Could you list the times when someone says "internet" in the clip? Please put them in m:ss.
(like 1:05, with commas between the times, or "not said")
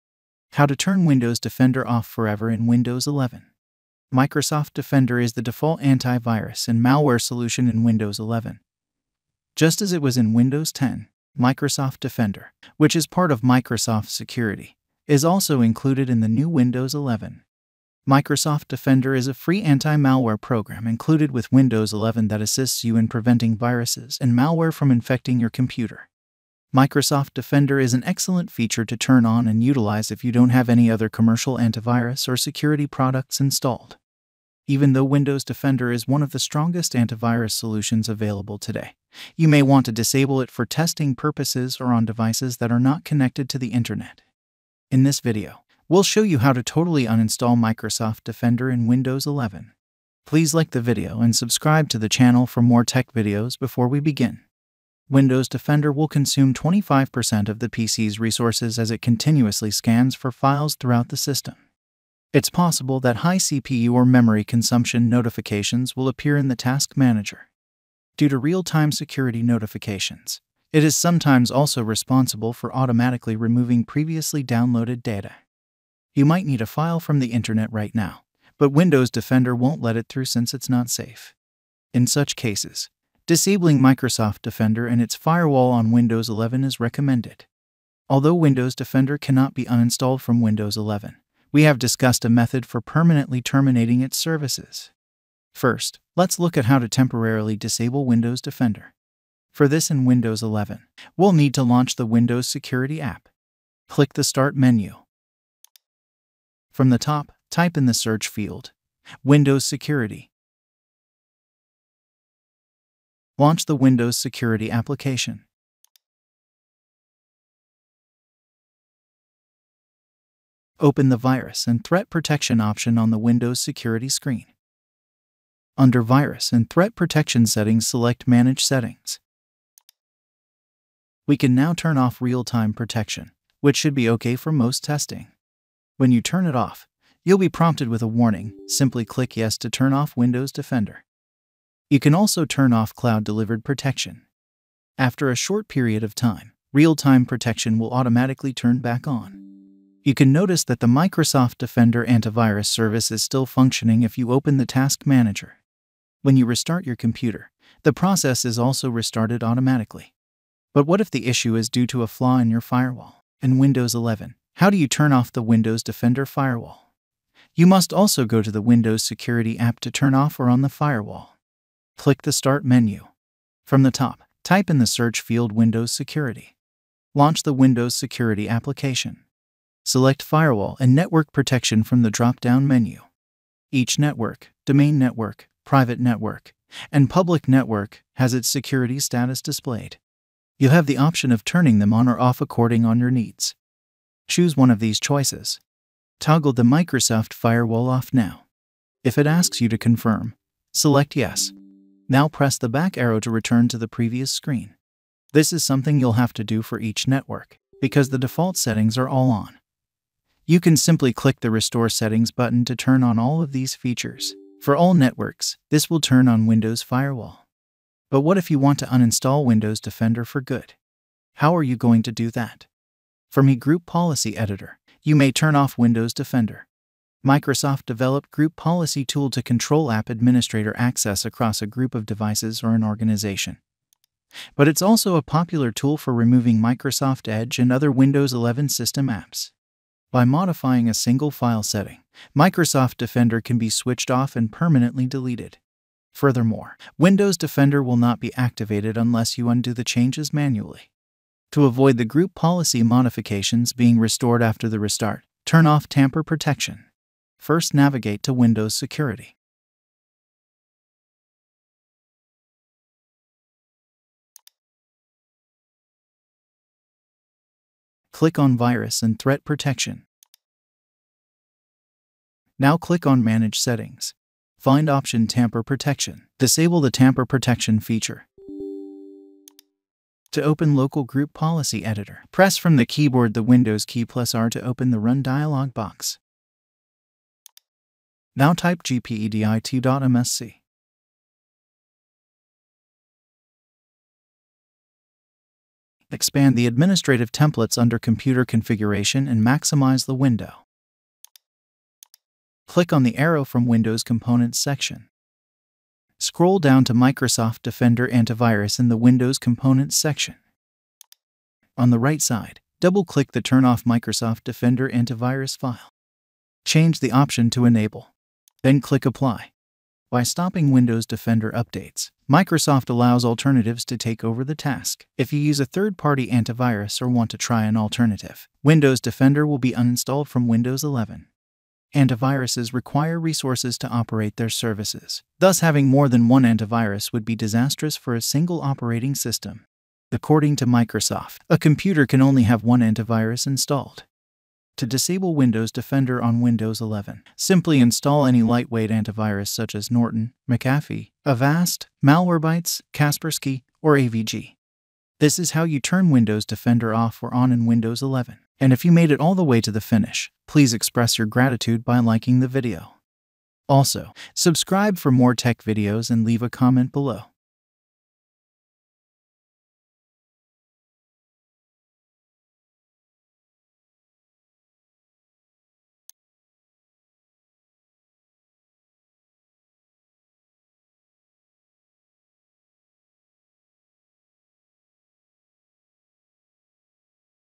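0:43, 1:17.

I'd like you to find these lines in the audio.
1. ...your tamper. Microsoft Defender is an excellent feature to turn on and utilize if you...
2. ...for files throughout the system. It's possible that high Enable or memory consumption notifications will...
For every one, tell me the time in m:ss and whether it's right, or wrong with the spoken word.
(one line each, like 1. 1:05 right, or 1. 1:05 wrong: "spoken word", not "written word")
1. 0:25 wrong: "computer", not "tamper"
2. 1:00 wrong: "CPU", not "Enable".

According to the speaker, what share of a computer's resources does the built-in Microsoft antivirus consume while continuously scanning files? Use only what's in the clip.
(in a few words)
25%.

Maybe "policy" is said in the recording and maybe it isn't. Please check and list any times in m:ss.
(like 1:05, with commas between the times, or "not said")
3:43, 3:48, 4:12, 4:41.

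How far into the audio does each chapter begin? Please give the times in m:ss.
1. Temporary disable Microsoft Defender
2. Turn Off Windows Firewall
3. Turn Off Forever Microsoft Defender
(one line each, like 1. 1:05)
1. 1:34
2. 2:37
3. 3:38.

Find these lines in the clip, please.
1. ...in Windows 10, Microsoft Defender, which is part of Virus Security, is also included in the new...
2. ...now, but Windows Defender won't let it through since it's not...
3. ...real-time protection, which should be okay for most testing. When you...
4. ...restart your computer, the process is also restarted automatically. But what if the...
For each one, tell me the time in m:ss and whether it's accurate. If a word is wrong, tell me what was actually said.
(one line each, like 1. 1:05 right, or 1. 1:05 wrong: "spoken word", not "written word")
1. 0:10 wrong: "Microsoft", not "Virus"
2. 1:17 right
3. 2:12 right
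4. 2:36 right.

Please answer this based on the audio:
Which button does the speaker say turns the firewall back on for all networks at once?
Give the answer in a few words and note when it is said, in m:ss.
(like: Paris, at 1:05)
Restore Settings, at 3:31.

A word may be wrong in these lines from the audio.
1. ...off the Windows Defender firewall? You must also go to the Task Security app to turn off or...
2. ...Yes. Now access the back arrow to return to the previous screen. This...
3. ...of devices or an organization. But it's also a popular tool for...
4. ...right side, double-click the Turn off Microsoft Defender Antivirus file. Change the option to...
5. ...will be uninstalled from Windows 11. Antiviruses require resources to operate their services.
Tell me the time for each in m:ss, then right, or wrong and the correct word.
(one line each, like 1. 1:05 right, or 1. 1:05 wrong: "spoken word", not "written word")
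1. 2:45 wrong: "Windows", not "Task"
2. 3:21 wrong: "press", not "access"
3. 3:51 right
4. 5:11 right
5. 5:29 right.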